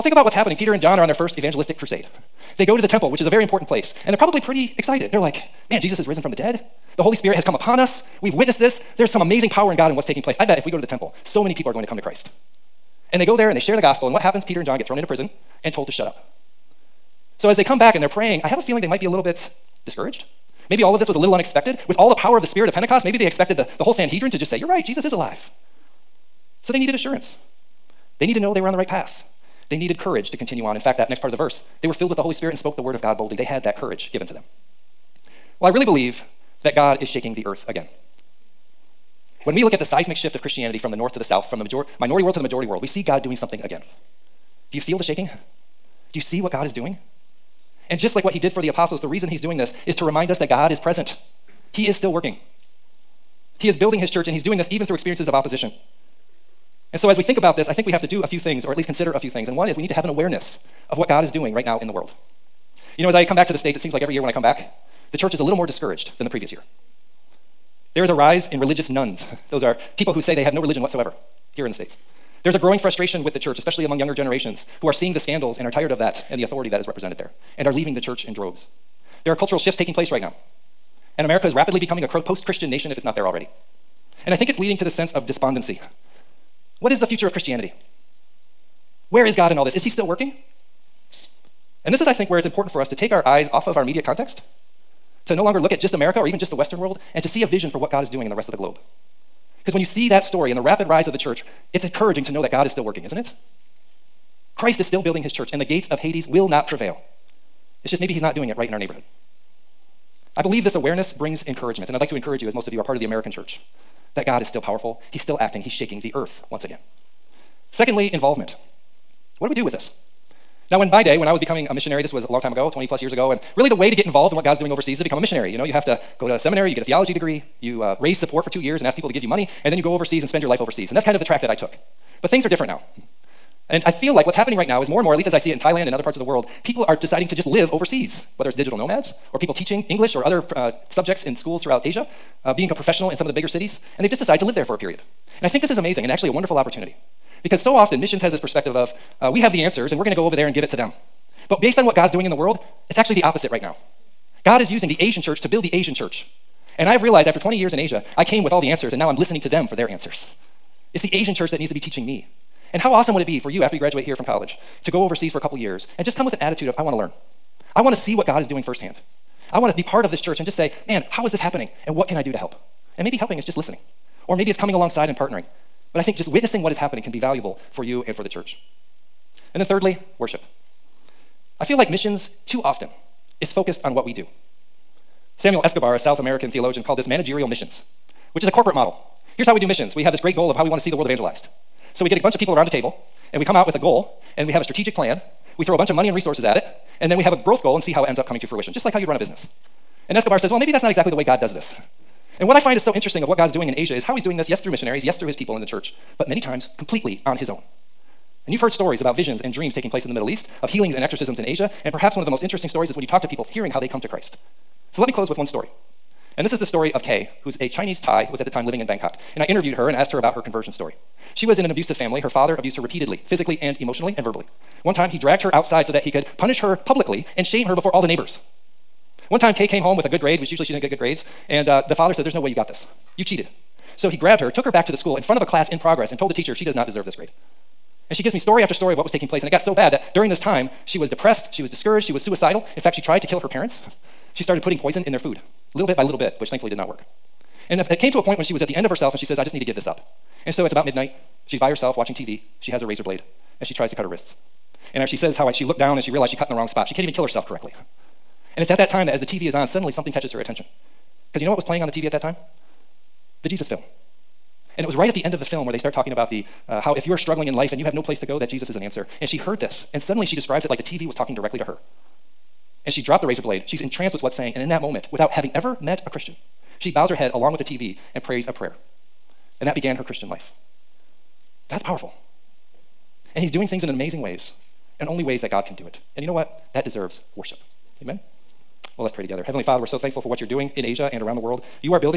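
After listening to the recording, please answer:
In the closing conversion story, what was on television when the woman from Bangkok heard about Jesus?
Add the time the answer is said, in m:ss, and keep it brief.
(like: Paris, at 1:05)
the Jesus film, at 4:23.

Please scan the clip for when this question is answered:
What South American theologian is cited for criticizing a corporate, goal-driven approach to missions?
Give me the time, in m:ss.
3:05.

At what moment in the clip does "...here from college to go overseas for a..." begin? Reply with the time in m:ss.
2:44.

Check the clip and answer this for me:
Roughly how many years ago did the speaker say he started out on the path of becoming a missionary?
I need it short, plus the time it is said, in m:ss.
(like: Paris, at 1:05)
20 plus years, at 2:02.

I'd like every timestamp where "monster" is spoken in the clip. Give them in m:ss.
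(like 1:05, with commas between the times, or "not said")
not said.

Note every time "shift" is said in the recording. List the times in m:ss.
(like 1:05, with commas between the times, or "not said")
0:40, 1:19.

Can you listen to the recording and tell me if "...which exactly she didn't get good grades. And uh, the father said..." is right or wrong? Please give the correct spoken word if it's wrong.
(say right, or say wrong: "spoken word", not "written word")
wrong: "usually", not "exactly".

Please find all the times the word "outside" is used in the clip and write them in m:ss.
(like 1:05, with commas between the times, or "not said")
3:45.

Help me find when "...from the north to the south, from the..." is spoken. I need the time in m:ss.
0:40.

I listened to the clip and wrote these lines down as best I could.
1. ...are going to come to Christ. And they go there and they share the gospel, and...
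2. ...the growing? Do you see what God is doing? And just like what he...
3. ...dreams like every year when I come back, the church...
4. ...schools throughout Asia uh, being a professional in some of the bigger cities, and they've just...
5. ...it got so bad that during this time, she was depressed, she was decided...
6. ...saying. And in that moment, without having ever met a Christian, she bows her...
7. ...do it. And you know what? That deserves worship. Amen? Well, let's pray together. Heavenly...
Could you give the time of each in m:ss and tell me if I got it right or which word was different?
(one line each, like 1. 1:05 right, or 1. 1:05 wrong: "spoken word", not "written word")
1. 0:11 right
2. 0:44 wrong: "shaking", not "growing"
3. 1:03 wrong: "seems", not "dreams"
4. 2:21 right
5. 3:59 wrong: "discouraged", not "decided"
6. 4:34 right
7. 4:45 right.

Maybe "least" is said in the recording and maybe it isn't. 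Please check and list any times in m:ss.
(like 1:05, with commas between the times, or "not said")
0:58, 2:15.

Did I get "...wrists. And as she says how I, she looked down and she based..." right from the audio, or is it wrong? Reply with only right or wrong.
wrong.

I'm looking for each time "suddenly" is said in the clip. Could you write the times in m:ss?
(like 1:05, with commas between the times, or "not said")
4:19, 4:29.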